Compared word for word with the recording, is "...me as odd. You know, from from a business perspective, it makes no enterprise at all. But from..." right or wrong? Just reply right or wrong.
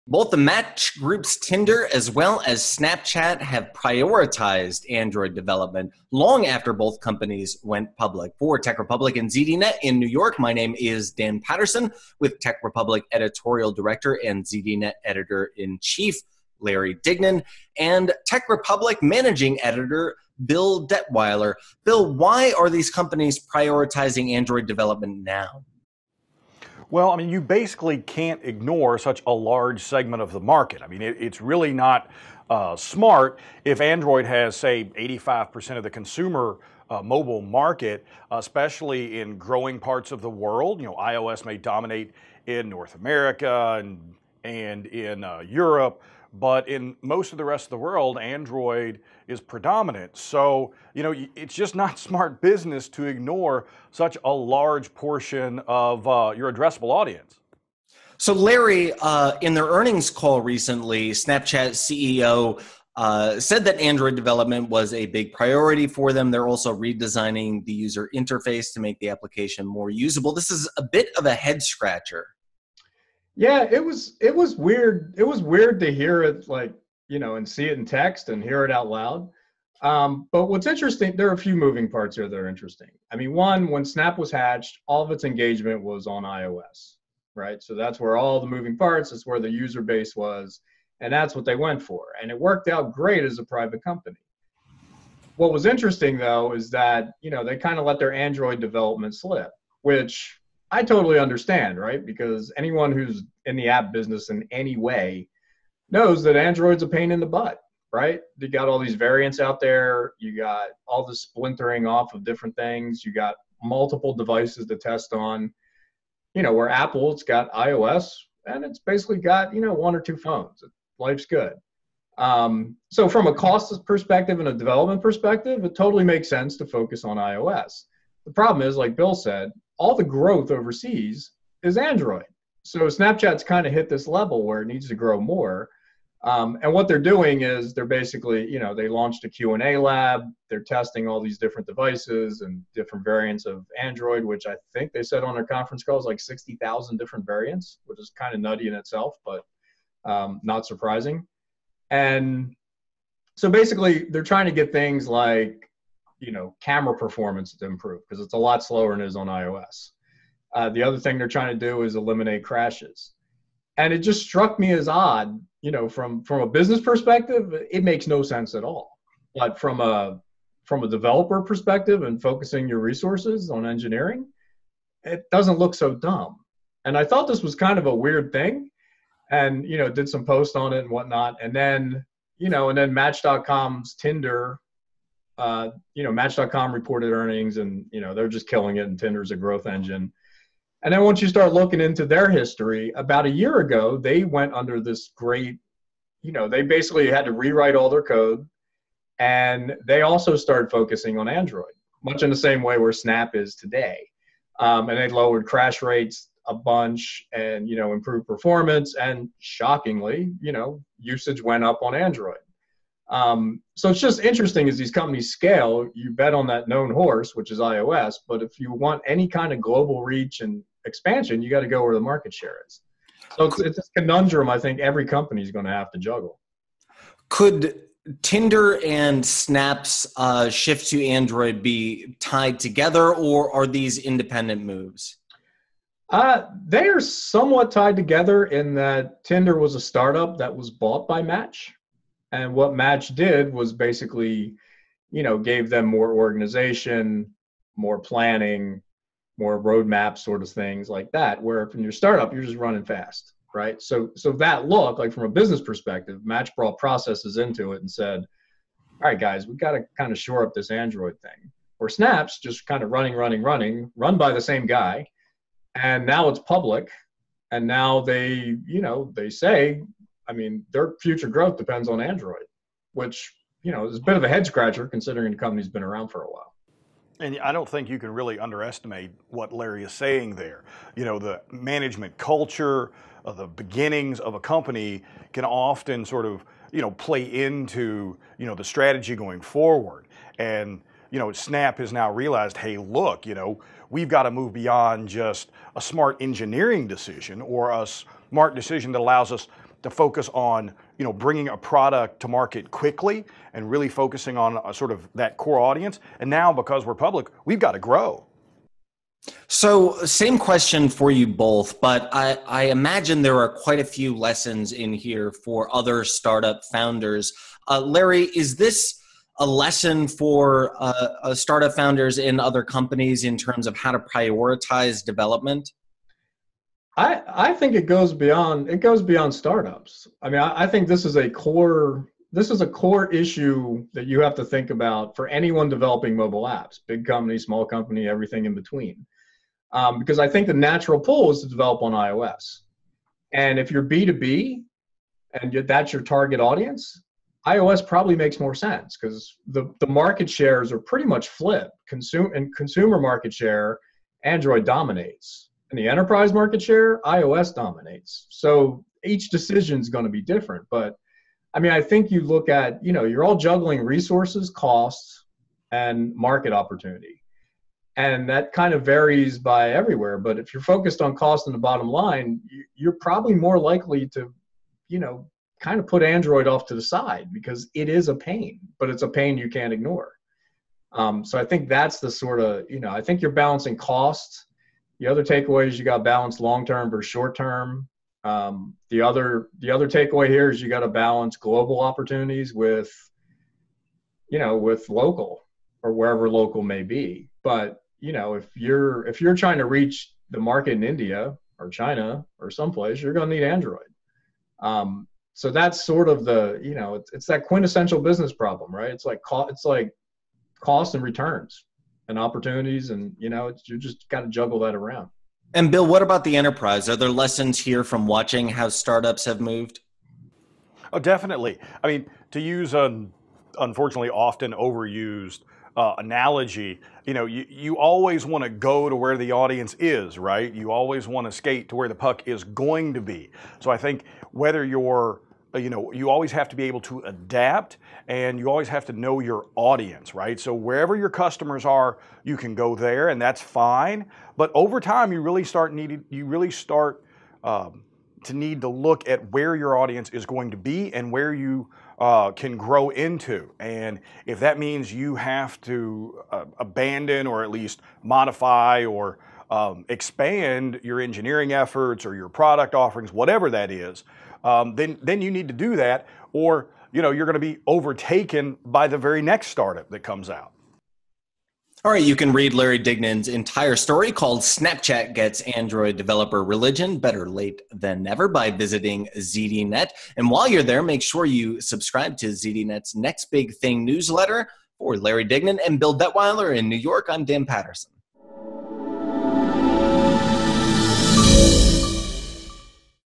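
wrong.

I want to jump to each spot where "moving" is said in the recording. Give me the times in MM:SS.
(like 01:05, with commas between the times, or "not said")
01:21, 01:28.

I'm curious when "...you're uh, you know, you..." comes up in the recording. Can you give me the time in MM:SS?
07:14.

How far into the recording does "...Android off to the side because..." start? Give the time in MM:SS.
06:16.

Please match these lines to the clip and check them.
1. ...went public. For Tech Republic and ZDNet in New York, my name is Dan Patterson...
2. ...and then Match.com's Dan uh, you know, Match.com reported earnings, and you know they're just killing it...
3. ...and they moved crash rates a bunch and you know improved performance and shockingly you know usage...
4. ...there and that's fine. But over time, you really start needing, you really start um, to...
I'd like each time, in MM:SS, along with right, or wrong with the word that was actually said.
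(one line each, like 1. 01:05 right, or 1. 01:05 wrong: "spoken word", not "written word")
1. 00:07 right
2. 03:02 wrong: "Tinder", not "Dan"
3. 03:24 wrong: "lowered", not "moved"
4. 07:22 right.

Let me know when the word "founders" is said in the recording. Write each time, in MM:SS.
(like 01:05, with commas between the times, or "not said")
05:16, 05:21.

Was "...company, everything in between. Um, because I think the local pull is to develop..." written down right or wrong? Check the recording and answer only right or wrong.
wrong.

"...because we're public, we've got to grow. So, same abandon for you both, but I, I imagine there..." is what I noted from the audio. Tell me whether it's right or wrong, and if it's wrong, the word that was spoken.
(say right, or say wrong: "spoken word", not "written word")
wrong: "question", not "abandon".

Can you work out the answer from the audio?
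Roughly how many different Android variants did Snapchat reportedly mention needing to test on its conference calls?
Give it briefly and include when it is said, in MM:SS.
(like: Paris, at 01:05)
60,000, at 02:26.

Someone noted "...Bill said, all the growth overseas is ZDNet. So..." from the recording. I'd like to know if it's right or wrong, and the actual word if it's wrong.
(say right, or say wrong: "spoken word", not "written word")
wrong: "Android", not "ZDNet".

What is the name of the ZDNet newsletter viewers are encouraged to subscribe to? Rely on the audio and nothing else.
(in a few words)
Next Big Thing.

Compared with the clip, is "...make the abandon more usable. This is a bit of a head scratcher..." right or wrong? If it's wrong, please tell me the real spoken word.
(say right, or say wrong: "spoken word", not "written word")
wrong: "application", not "abandon".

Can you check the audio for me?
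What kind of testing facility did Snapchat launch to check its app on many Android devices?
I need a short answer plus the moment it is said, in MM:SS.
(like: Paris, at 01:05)
Q&A lab, at 02:19.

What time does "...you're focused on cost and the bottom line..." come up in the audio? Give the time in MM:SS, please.
06:10.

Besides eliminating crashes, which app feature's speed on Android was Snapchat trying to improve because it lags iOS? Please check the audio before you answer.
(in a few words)
camera performance.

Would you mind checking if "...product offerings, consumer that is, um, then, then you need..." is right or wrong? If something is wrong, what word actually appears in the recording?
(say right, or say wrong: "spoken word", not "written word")
wrong: "whatever", not "consumer".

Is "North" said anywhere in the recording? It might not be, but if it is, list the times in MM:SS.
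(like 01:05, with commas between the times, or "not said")
00:42.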